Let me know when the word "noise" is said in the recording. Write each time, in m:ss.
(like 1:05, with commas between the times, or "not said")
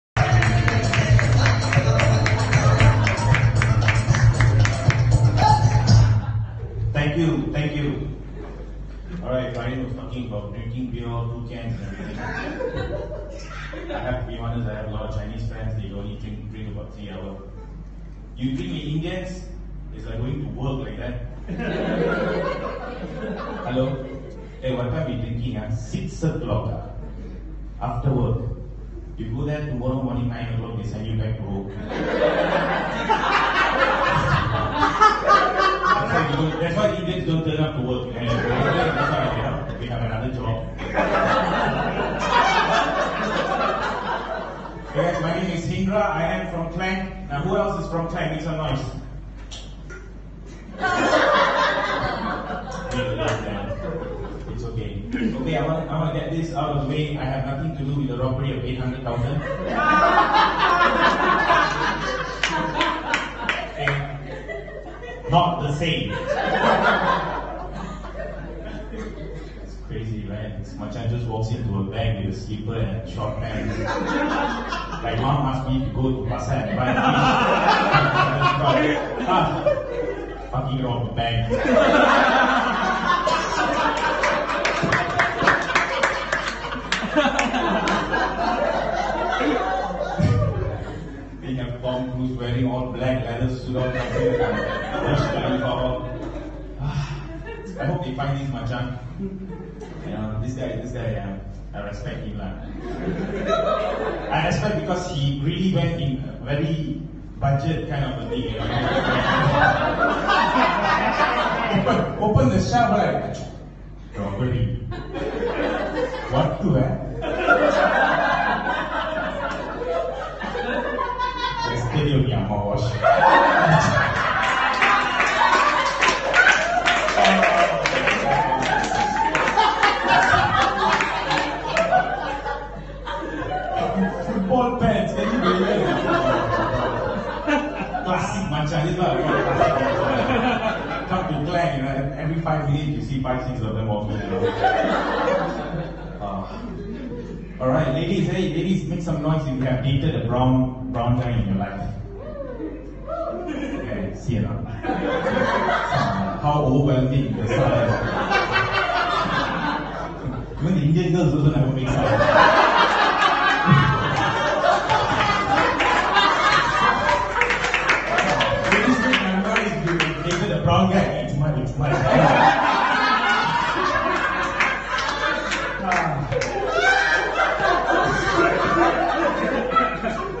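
0:48, 2:29.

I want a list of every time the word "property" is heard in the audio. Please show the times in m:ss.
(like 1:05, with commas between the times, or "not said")
1:54.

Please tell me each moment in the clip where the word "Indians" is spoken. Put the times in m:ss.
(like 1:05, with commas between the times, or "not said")
0:18, 2:40.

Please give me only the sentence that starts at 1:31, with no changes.
they have Tom Cruise wearing all black leather suit on.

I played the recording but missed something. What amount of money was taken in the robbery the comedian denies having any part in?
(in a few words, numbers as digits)
800,000.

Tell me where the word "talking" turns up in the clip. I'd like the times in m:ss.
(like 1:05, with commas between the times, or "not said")
0:09.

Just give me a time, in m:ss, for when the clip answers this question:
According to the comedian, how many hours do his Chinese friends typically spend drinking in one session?
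0:16.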